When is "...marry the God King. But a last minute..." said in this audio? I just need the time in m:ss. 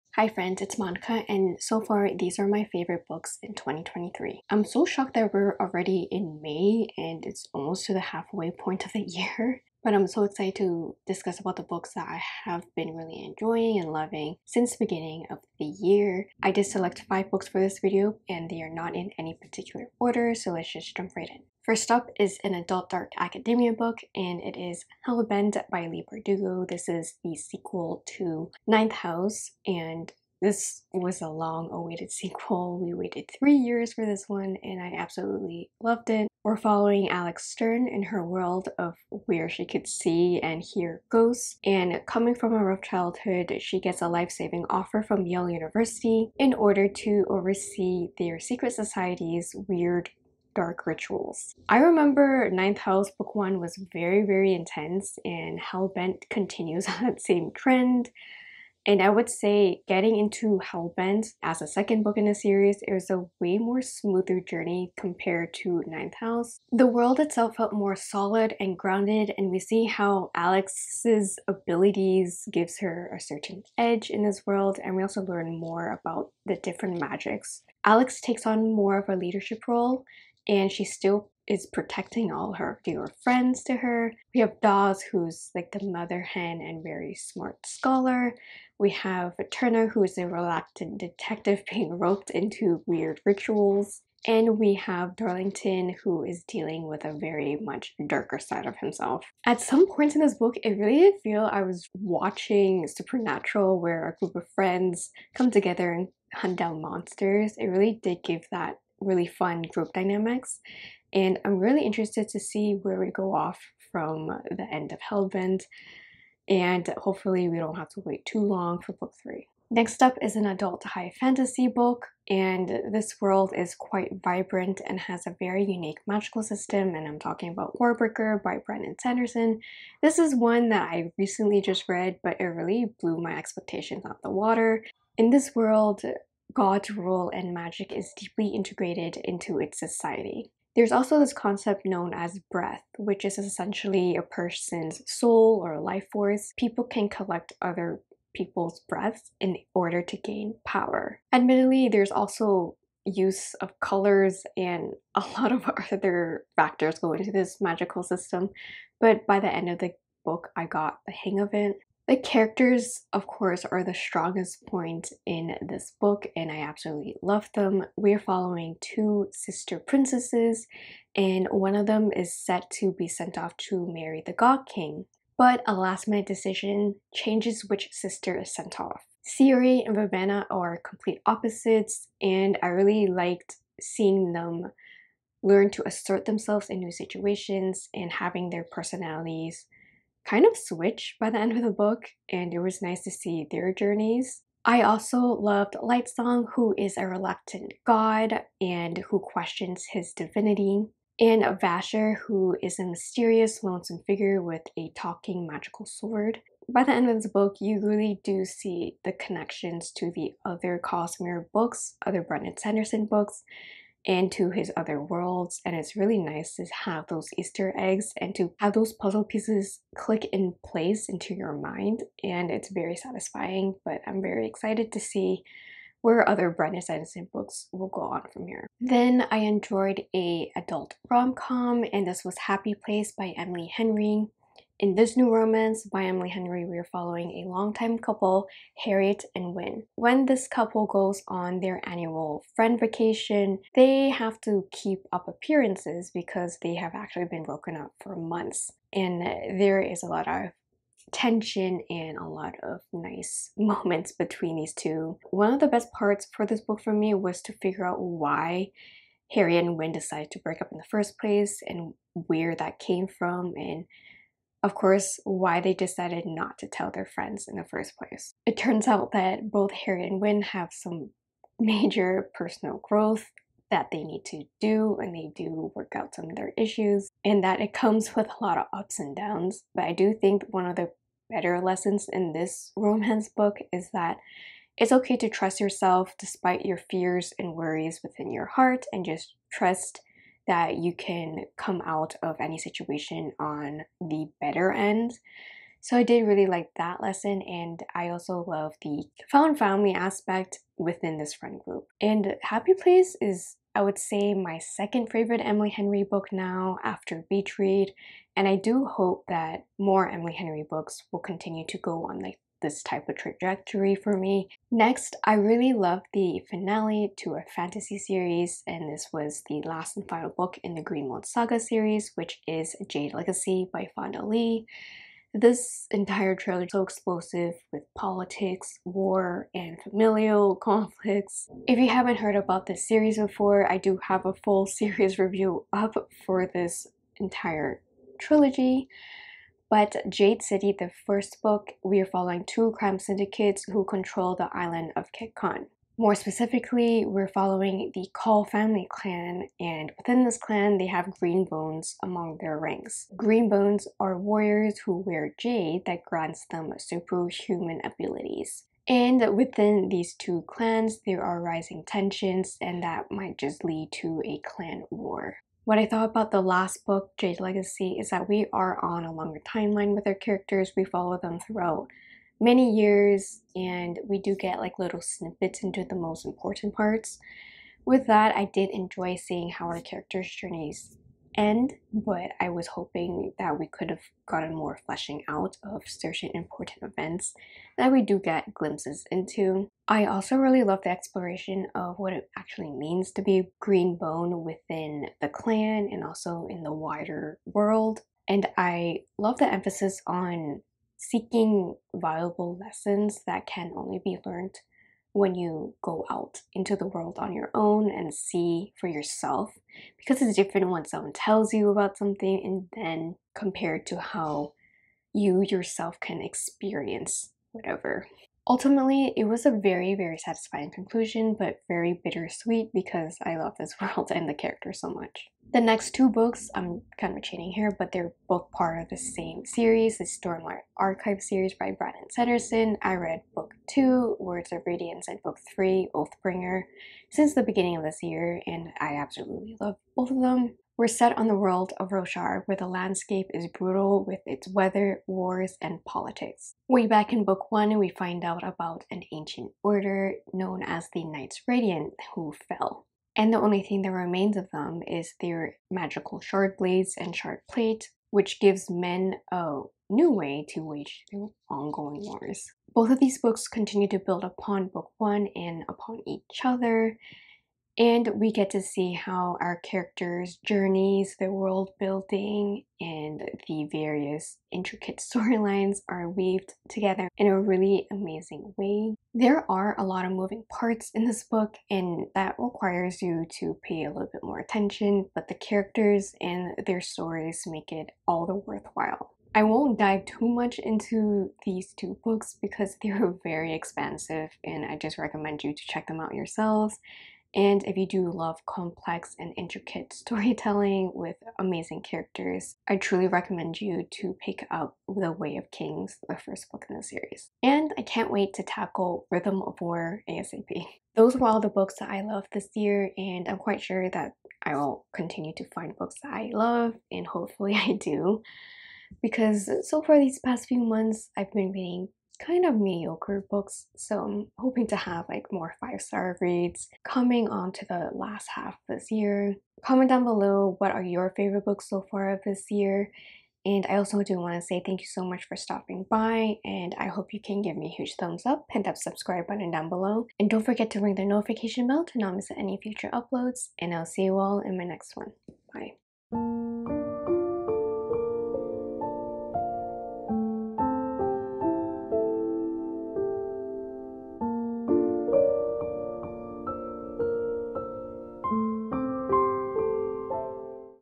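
2:53.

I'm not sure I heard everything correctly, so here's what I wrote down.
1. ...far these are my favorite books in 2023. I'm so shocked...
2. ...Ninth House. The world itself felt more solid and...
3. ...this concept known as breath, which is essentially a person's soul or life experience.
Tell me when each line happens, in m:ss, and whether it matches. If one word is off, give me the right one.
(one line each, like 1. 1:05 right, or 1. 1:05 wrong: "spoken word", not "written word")
1. 0:01 right
2. 1:05 right
3. 2:21 wrong: "force", not "experience".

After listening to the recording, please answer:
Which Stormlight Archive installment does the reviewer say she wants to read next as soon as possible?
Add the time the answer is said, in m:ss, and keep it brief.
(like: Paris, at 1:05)
Rhythm of War, at 8:29.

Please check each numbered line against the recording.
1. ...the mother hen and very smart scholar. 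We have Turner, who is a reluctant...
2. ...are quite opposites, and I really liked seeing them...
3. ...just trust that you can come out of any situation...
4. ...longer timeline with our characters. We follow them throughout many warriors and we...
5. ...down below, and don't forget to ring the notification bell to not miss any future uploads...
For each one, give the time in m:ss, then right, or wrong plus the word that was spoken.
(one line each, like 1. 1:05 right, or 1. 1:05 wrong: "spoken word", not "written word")
1. 1:25 right
2. 3:00 wrong: "complete", not "quite"
3. 4:49 right
4. 6:09 wrong: "years", not "warriors"
5. 8:59 right.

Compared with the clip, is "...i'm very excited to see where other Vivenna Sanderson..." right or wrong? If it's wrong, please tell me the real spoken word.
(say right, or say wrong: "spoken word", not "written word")
wrong: "Brandon", not "Vivenna".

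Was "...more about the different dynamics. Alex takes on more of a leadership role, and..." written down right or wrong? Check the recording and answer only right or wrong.
wrong.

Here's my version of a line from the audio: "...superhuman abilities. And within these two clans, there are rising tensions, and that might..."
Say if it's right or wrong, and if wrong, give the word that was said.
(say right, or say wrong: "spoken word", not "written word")
right.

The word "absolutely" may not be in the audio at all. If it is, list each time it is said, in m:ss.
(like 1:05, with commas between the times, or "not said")
0:34, 2:46, 7:18.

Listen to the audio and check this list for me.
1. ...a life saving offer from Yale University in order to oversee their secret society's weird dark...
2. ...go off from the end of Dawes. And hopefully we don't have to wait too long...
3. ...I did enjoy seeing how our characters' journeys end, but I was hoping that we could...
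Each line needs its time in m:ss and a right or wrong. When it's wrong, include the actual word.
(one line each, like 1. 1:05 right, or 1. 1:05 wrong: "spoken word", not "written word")
1. 0:44 right
2. 1:53 wrong: "Hellbent", not "Dawes"
3. 6:18 right.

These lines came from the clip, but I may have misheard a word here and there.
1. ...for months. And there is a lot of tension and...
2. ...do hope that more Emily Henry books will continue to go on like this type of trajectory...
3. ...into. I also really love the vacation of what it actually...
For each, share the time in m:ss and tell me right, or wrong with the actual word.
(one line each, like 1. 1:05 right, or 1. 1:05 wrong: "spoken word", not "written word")
1. 4:08 right
2. 5:08 right
3. 6:29 wrong: "exploration", not "vacation".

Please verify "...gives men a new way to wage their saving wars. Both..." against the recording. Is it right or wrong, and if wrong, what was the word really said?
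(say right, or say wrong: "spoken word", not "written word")
wrong: "ongoing", not "saving".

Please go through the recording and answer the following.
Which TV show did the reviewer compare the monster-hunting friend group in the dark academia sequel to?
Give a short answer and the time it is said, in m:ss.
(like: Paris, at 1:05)
Supernatural, at 1:42.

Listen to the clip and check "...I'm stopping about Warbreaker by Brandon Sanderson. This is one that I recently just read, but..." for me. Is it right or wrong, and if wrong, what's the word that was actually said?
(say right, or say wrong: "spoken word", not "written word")
wrong: "talking", not "stopping".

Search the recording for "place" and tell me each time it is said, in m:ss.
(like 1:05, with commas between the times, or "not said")
3:40, 3:52, 4:21, 4:27, 5:02.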